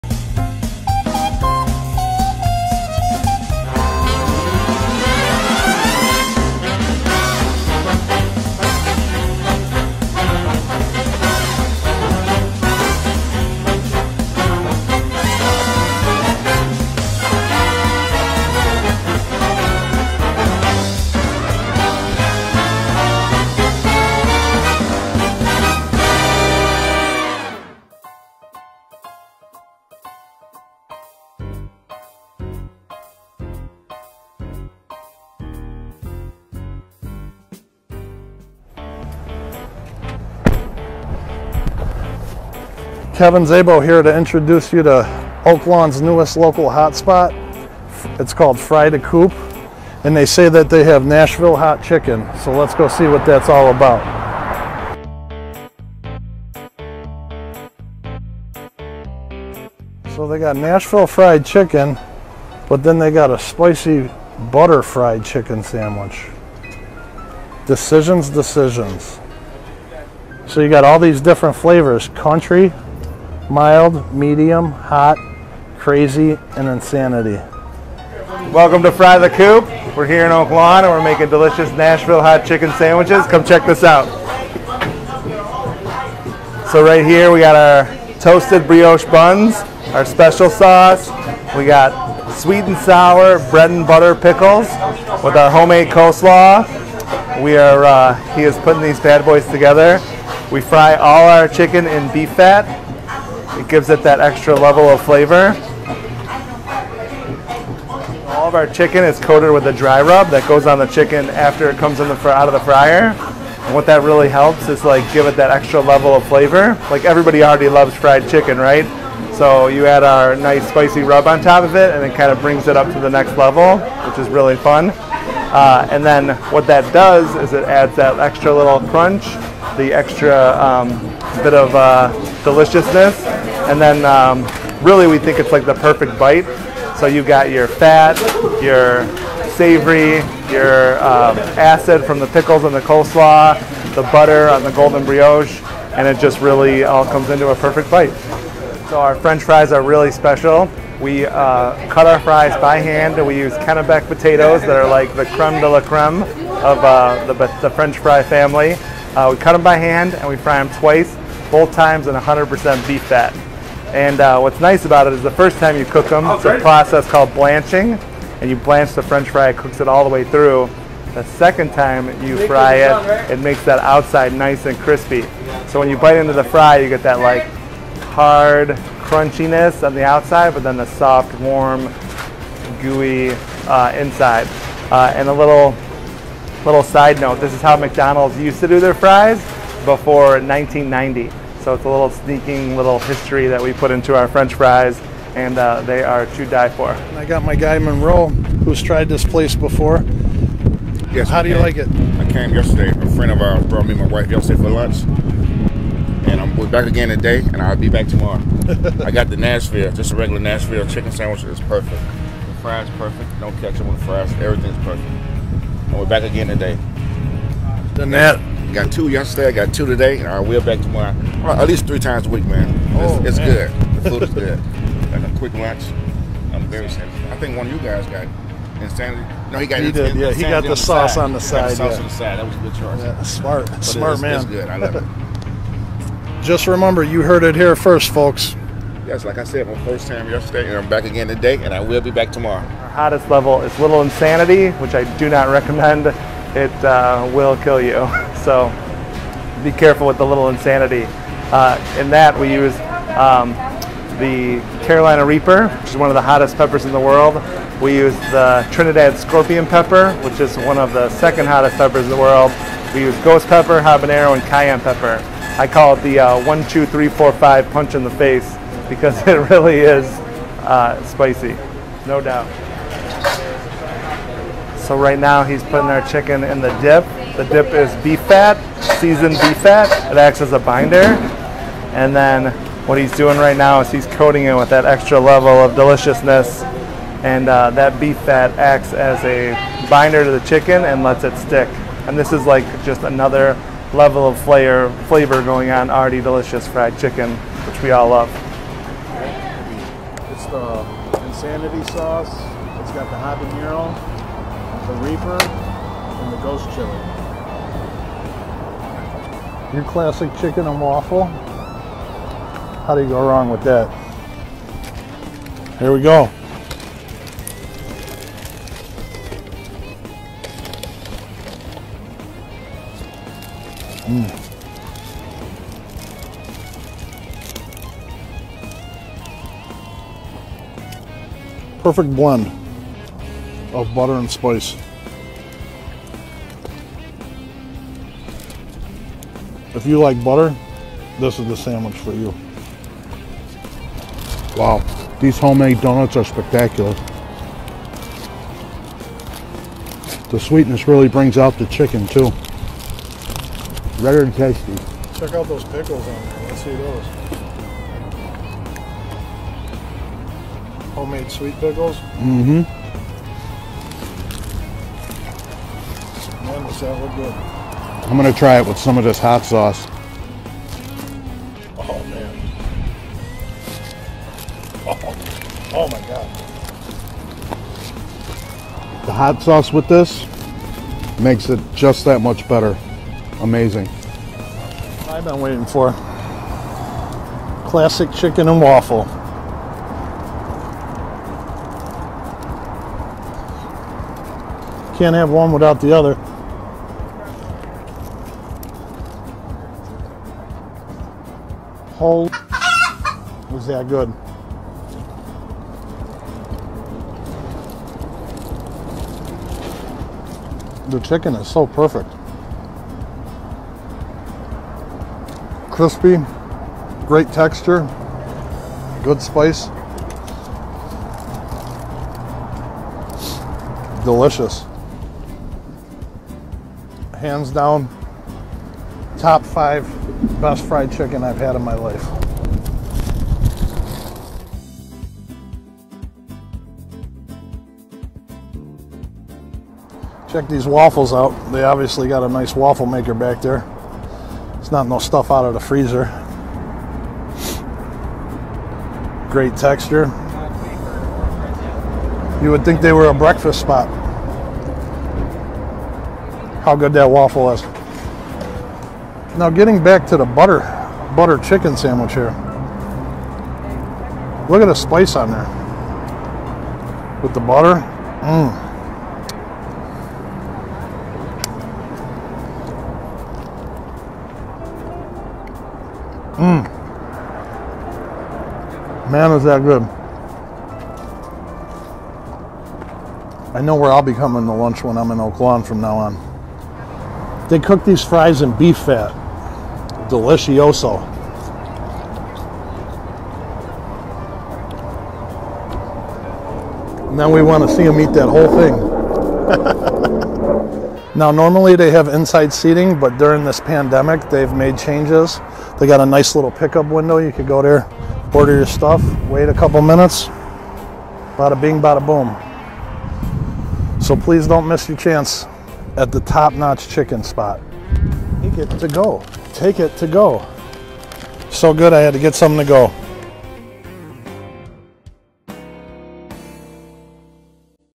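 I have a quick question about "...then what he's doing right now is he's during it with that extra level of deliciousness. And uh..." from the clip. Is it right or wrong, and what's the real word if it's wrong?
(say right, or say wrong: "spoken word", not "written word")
wrong: "coating", not "during".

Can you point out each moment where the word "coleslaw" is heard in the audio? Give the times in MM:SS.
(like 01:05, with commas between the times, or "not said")
01:35, 02:22.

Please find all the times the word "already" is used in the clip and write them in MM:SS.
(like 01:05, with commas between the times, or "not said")
01:57, 04:55.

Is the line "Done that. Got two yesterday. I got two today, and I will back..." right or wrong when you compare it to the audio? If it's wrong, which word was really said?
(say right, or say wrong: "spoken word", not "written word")
right.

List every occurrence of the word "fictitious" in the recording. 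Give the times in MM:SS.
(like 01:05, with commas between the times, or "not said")
not said.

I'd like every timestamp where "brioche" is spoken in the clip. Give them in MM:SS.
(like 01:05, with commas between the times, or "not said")
01:28, 02:25.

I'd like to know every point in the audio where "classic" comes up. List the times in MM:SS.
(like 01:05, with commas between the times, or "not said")
05:09, 06:27.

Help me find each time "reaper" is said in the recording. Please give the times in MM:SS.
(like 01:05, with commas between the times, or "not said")
04:15, 05:05.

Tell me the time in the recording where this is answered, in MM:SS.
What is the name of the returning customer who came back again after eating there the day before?
03:17.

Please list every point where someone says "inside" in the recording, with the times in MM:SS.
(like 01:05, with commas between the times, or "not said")
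03:03, 08:22.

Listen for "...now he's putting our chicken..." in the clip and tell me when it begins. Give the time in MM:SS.
04:35.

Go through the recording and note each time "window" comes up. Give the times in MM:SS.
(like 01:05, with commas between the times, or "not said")
08:26.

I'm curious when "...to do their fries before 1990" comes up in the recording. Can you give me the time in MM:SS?
03:08.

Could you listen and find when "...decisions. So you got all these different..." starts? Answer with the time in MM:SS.
01:08.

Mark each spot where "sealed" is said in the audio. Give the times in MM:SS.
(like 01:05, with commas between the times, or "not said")
not said.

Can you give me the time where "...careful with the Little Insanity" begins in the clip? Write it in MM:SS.
04:09.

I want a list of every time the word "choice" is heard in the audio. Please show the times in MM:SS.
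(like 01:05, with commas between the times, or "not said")
03:52.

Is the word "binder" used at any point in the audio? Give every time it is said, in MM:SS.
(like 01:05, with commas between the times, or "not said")
04:40, 04:49.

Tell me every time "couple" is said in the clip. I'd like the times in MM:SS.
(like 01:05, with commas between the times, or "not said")
08:29.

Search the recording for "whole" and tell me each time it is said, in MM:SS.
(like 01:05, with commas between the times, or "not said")
06:41, 08:18.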